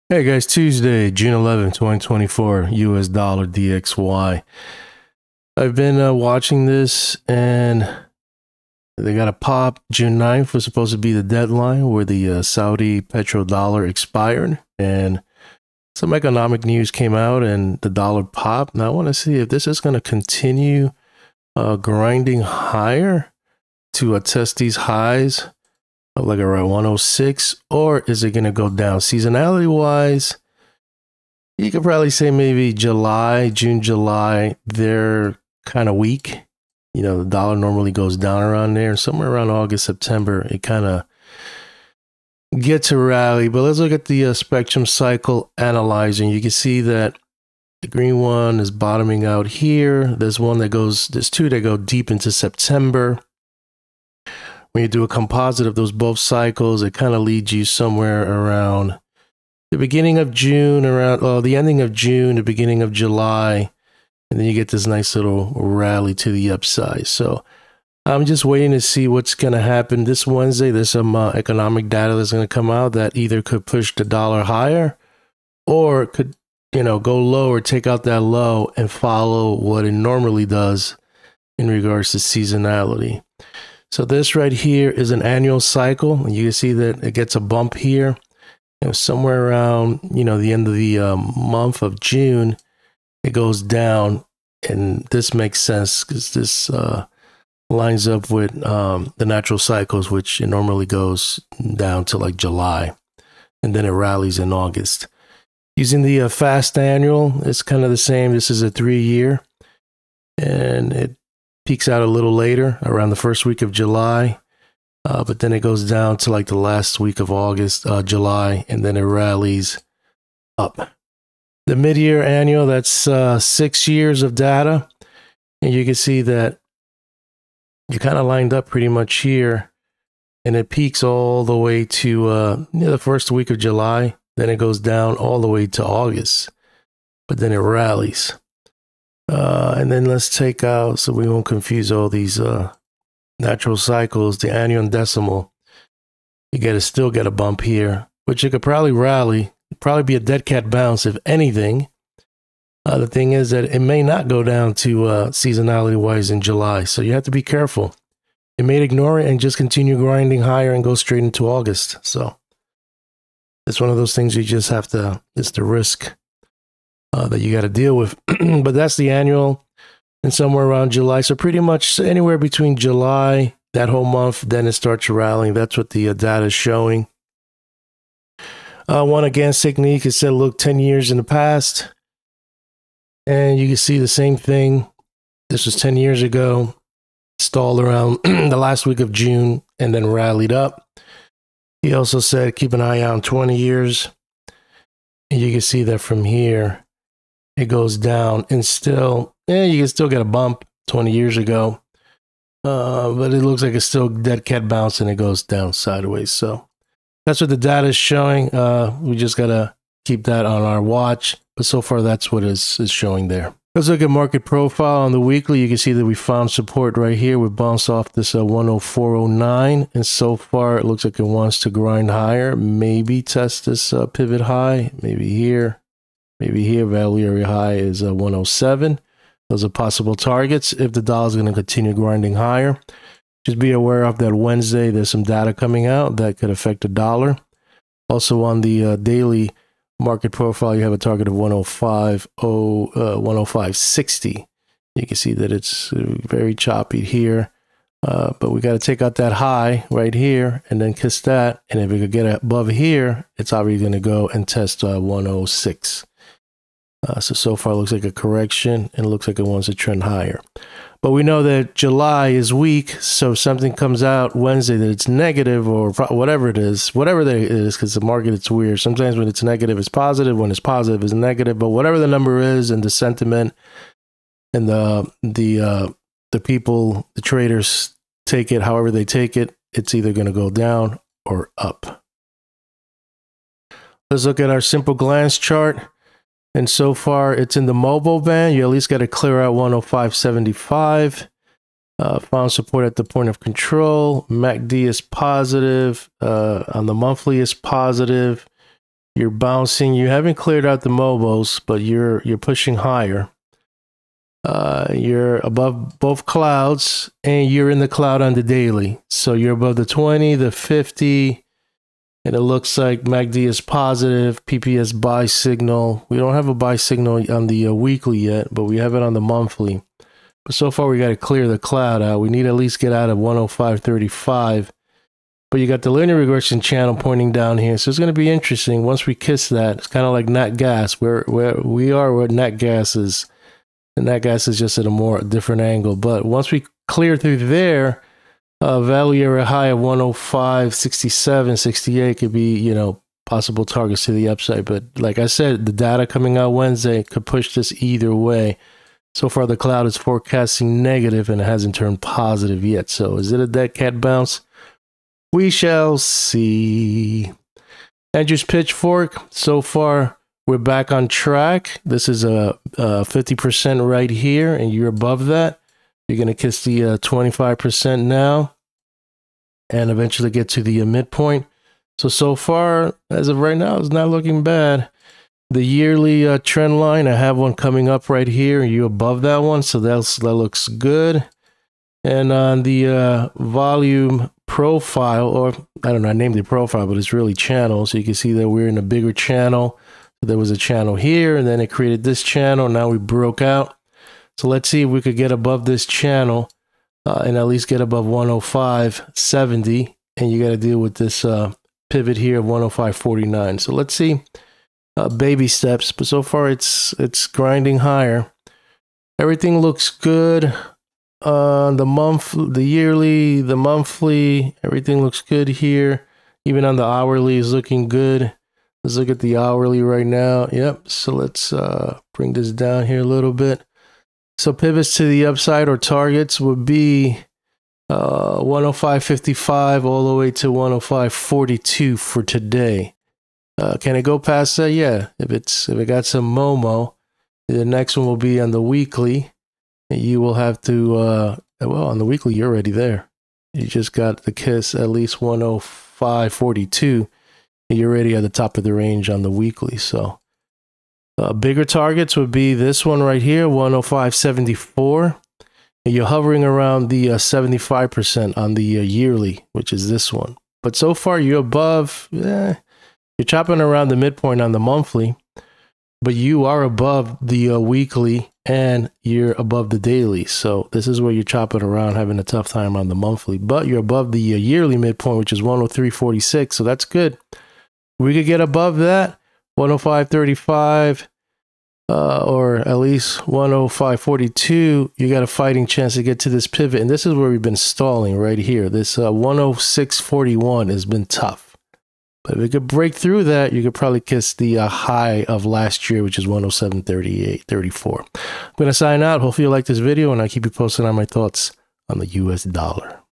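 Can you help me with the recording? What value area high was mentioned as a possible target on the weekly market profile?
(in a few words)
107.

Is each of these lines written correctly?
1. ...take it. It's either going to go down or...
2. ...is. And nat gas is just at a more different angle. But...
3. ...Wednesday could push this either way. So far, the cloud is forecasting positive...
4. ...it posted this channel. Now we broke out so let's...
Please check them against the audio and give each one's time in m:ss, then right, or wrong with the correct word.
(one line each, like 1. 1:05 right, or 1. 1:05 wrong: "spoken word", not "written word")
1. 4:39 right
2. 5:32 right
3. 5:46 wrong: "negative", not "positive"
4. 6:31 wrong: "created", not "posted".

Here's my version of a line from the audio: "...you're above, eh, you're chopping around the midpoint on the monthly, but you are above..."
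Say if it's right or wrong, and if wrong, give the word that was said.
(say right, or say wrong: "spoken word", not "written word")
right.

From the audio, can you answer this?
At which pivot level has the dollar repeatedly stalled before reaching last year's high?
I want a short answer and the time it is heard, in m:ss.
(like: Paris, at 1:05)
106.41, at 8:09.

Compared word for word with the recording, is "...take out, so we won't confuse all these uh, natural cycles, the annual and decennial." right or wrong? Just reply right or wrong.
right.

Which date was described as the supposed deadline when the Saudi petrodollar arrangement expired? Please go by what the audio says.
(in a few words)
June 9th.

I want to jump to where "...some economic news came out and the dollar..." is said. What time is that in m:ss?
0:15.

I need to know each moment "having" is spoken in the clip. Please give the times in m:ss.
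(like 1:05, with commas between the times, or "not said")
7:51.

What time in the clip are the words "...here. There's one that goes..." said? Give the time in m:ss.
0:49.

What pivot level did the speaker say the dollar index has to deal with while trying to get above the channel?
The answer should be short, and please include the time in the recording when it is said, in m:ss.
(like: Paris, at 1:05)
105.49, at 6:42.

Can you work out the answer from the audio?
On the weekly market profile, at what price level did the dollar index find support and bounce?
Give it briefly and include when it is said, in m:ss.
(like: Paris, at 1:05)
104.09, at 3:38.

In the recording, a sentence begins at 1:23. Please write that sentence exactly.
So this right here is an annual cycle.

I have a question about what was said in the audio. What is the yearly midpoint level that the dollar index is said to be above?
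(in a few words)
103.46.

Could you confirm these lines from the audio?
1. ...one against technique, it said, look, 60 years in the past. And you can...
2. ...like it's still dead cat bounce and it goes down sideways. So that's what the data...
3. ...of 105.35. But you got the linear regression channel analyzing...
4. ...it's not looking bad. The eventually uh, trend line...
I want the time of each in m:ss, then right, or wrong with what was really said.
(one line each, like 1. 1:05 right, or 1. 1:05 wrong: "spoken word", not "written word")
1. 2:59 wrong: "10", not "60"
2. 3:23 right
3. 5:23 wrong: "pointing", not "analyzing"
4. 6:13 wrong: "yearly", not "eventually".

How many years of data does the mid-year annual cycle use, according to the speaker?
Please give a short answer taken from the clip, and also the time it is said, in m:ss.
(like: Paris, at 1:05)
6 years, at 2:03.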